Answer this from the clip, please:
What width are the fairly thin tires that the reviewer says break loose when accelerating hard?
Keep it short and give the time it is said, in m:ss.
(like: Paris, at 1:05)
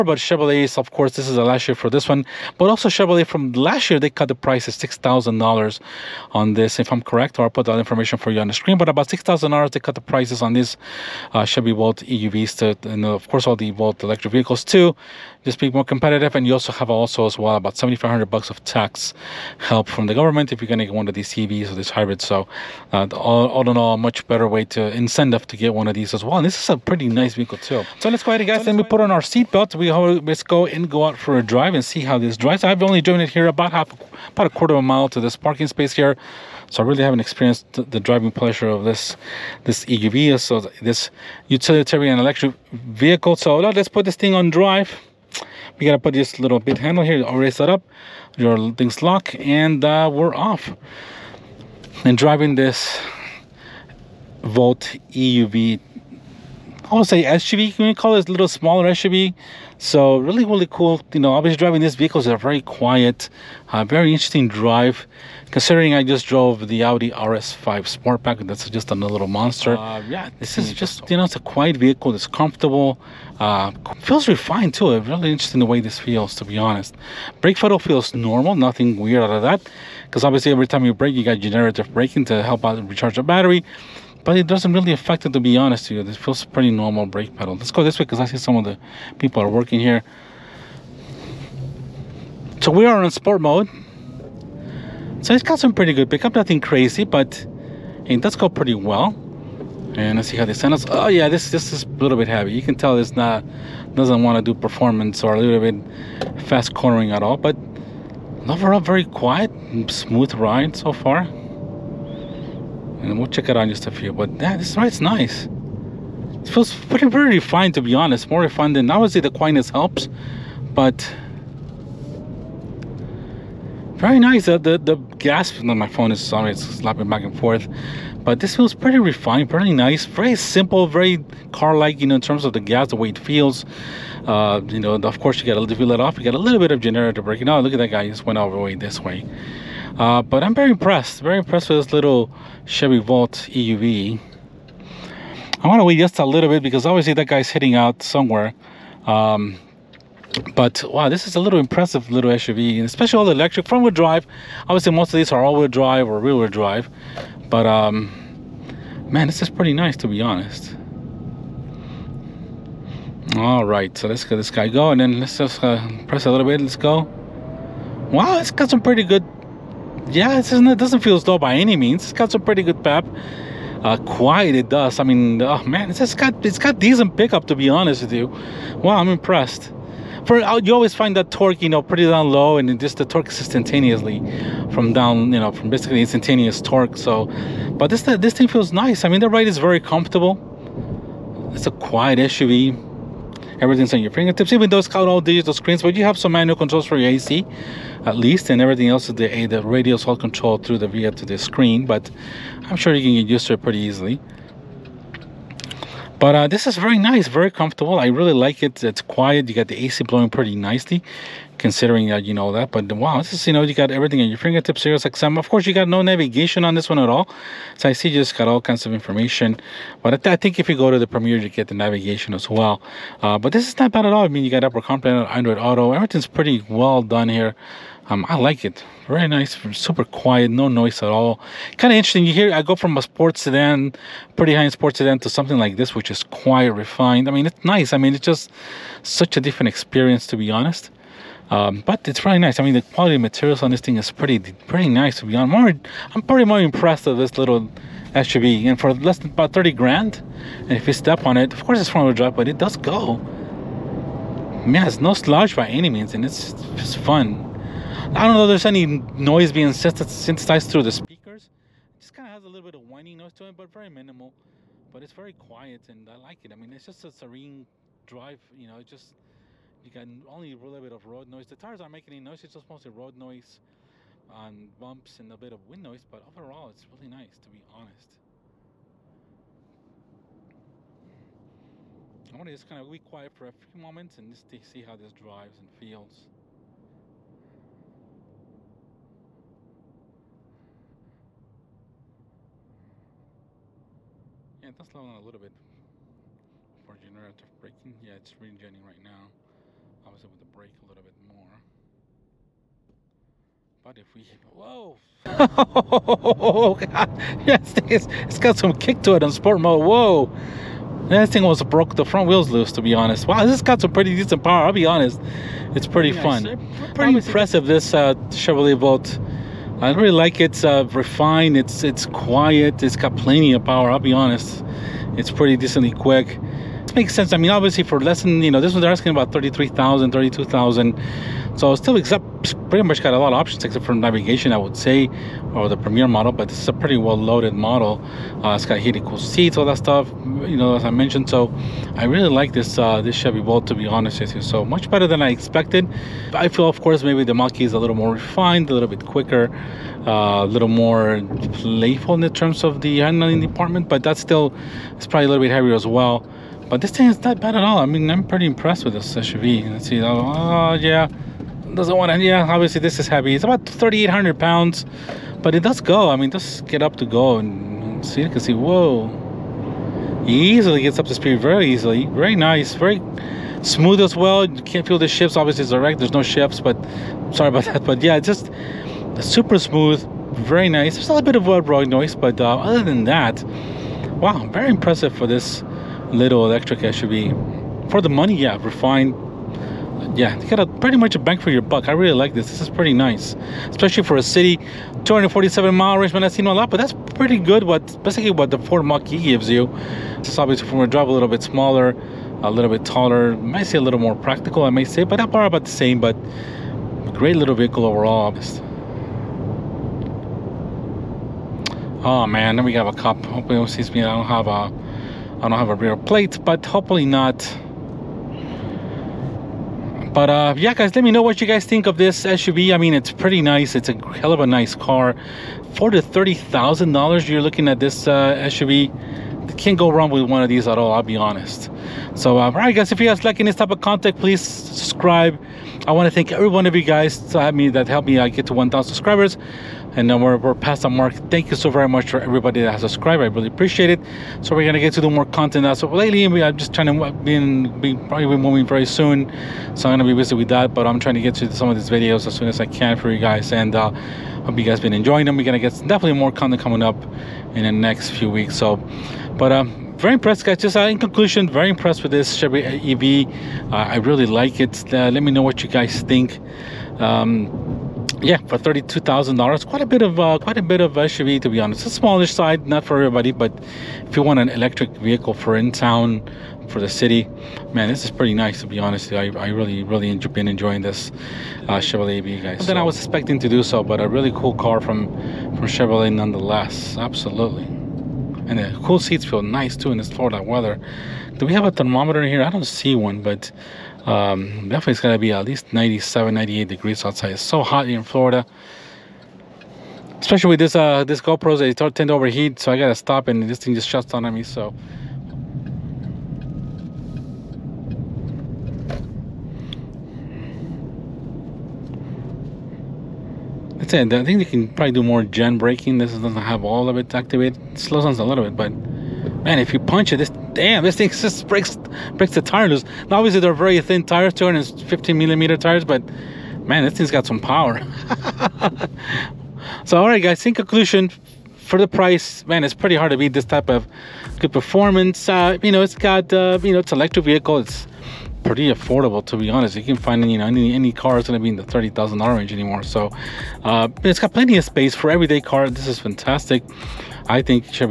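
215 millimeters, at 8:44.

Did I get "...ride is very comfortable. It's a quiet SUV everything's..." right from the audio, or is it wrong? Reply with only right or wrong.
right.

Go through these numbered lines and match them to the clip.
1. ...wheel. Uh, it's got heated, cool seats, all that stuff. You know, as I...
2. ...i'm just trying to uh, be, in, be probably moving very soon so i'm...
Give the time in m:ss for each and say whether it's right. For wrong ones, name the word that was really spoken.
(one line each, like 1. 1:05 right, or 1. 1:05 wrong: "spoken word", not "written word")
1. 5:37 wrong: "model", not "wheel"
2. 7:26 right.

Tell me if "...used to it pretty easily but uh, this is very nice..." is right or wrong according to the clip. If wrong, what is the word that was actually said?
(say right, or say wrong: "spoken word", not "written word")
right.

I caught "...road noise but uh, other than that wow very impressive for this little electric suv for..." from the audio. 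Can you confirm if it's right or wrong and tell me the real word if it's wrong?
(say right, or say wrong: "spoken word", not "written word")
right.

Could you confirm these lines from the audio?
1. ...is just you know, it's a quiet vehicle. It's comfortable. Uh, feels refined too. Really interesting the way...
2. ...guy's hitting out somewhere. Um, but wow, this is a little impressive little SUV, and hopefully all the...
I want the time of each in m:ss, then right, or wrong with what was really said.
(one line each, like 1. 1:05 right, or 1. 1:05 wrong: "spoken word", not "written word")
1. 1:10 right
2. 2:27 wrong: "especially", not "hopefully".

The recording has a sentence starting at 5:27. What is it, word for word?
I mean, obviously for less than you know, this one they're asking about 33,000, 32,000.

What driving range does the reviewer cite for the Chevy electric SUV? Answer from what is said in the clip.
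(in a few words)
247 miles.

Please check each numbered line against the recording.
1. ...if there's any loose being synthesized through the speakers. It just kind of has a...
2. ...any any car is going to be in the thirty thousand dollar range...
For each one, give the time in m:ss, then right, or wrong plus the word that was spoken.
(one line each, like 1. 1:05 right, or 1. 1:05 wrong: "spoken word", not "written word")
1. 4:18 wrong: "noise", not "loose"
2. 9:00 right.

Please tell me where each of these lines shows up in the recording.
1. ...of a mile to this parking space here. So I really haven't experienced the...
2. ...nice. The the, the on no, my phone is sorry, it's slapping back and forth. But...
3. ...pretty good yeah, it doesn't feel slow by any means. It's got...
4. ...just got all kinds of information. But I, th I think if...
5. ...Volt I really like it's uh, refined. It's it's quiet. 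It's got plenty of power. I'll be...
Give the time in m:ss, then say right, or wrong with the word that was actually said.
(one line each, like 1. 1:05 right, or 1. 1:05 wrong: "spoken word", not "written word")
1. 0:34 right
2. 2:04 right
3. 2:48 right
4. 3:38 right
5. 5:18 right.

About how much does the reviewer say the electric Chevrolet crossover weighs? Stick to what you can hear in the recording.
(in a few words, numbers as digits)
3,800 pounds.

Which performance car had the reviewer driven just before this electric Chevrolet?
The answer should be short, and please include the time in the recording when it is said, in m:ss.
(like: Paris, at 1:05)
Audi RS5 Sportback, at 1:06.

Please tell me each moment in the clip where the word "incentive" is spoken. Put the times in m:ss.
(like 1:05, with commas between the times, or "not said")
0:24.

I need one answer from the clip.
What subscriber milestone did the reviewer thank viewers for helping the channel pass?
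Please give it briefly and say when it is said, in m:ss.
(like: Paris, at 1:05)
1,000 subscribers, at 7:18.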